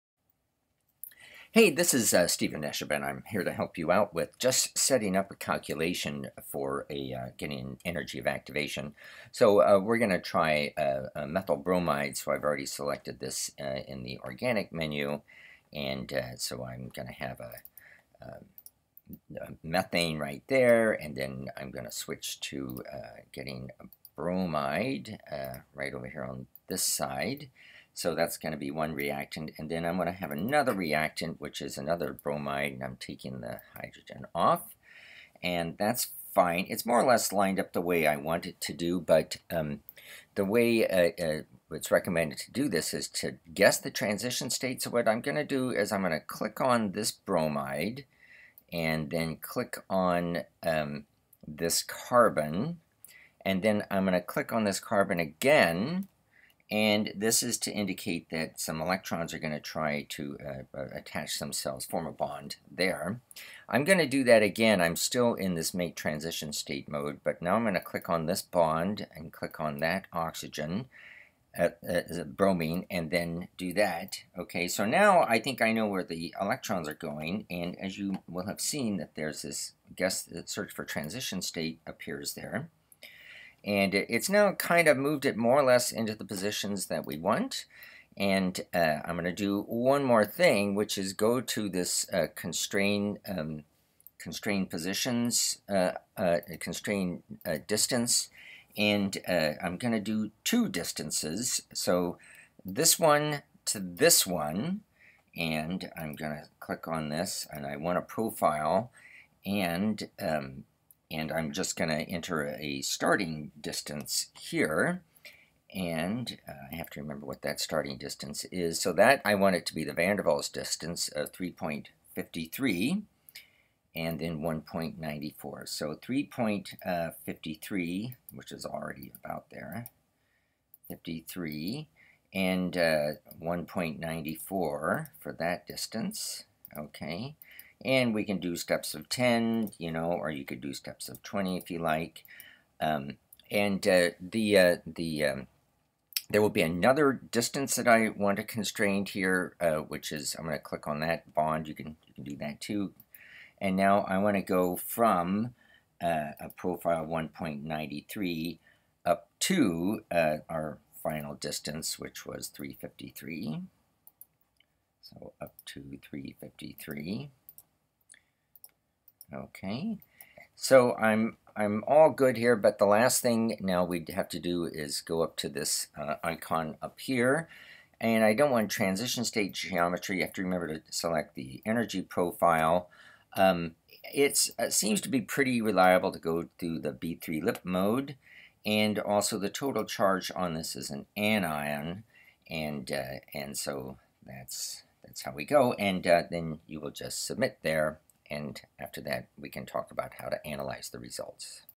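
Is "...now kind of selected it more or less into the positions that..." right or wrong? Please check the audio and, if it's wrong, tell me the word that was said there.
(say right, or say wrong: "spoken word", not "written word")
wrong: "moved", not "selected".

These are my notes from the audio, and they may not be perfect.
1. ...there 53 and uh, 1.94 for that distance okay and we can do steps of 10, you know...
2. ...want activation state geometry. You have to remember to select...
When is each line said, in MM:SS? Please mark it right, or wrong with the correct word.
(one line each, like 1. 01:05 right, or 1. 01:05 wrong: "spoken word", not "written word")
1. 02:09 right
2. 02:58 wrong: "transition", not "activation".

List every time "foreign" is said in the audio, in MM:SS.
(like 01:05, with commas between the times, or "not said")
not said.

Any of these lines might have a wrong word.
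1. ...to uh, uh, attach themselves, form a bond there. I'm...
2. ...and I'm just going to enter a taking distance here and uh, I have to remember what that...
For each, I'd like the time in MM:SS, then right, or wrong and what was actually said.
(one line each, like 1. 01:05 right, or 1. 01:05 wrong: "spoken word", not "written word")
1. 01:00 right
2. 01:51 wrong: "starting", not "taking".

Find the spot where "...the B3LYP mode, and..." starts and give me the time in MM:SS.
03:06.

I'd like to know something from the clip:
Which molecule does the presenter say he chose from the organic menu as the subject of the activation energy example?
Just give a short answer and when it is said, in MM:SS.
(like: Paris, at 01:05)
methyl bromide, at 00:11.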